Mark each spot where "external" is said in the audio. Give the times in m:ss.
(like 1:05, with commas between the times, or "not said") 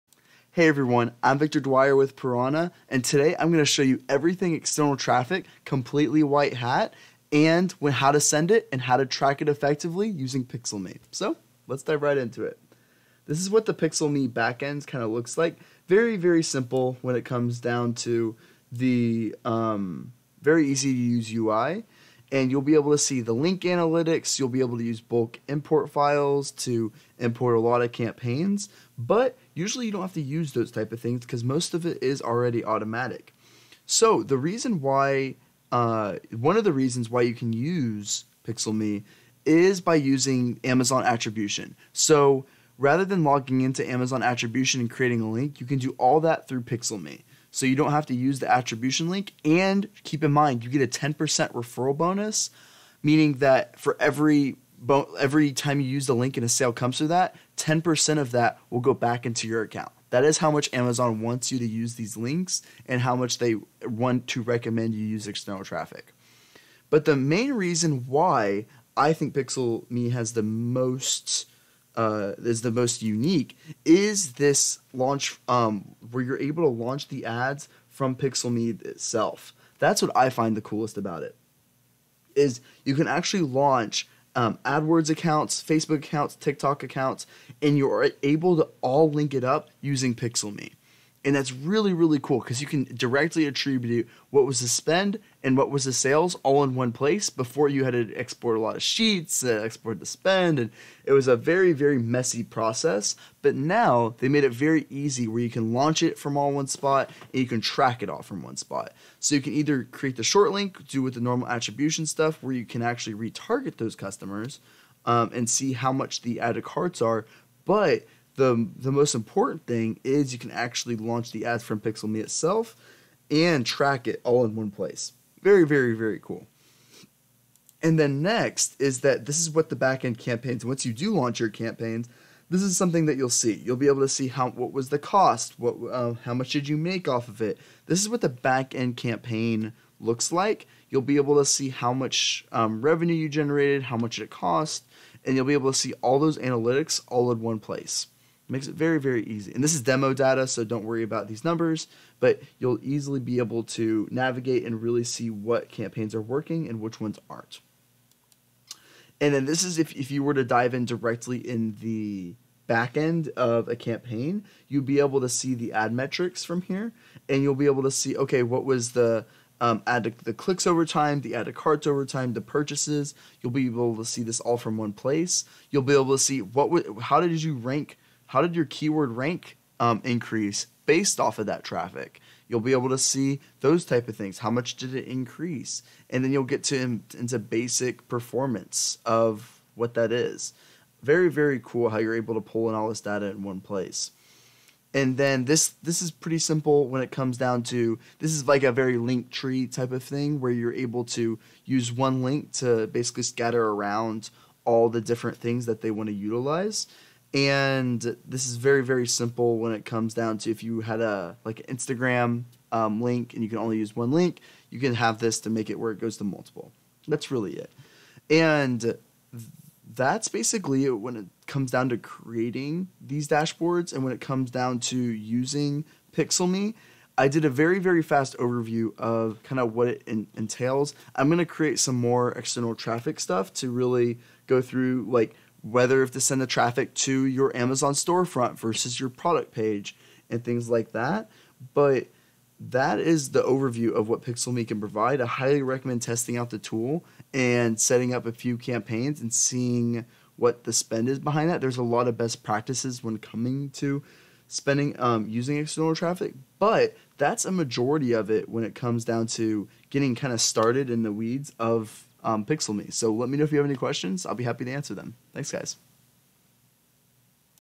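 0:04, 1:05, 3:52, 4:15.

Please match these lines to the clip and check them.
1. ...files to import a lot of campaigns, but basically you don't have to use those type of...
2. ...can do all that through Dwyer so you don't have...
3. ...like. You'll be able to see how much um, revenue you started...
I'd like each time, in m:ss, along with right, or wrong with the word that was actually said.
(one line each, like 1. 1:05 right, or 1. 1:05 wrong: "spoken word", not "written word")
1. 0:25 wrong: "usually", not "basically"
2. 0:45 wrong: "PixelMe", not "Dwyer"
3. 2:20 wrong: "generated", not "started".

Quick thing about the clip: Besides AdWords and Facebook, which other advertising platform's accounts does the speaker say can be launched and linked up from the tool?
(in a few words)
TikTok.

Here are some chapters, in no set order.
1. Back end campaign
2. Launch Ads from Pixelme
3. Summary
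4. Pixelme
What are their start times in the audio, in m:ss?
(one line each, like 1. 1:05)
1. 2:08
2. 1:06
3. 3:44
4. 0:13.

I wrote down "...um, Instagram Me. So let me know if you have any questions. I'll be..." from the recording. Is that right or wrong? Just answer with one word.
wrong.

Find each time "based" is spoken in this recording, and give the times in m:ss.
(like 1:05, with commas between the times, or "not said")
3:00.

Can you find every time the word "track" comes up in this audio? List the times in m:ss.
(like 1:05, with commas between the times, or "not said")
0:09, 1:47, 2:03.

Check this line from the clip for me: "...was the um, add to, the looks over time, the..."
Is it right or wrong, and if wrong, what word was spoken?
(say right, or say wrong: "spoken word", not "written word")
wrong: "clicks", not "looks".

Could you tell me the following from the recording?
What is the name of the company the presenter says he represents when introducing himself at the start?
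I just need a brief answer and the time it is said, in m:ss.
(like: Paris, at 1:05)
Pirawna, at 0:02.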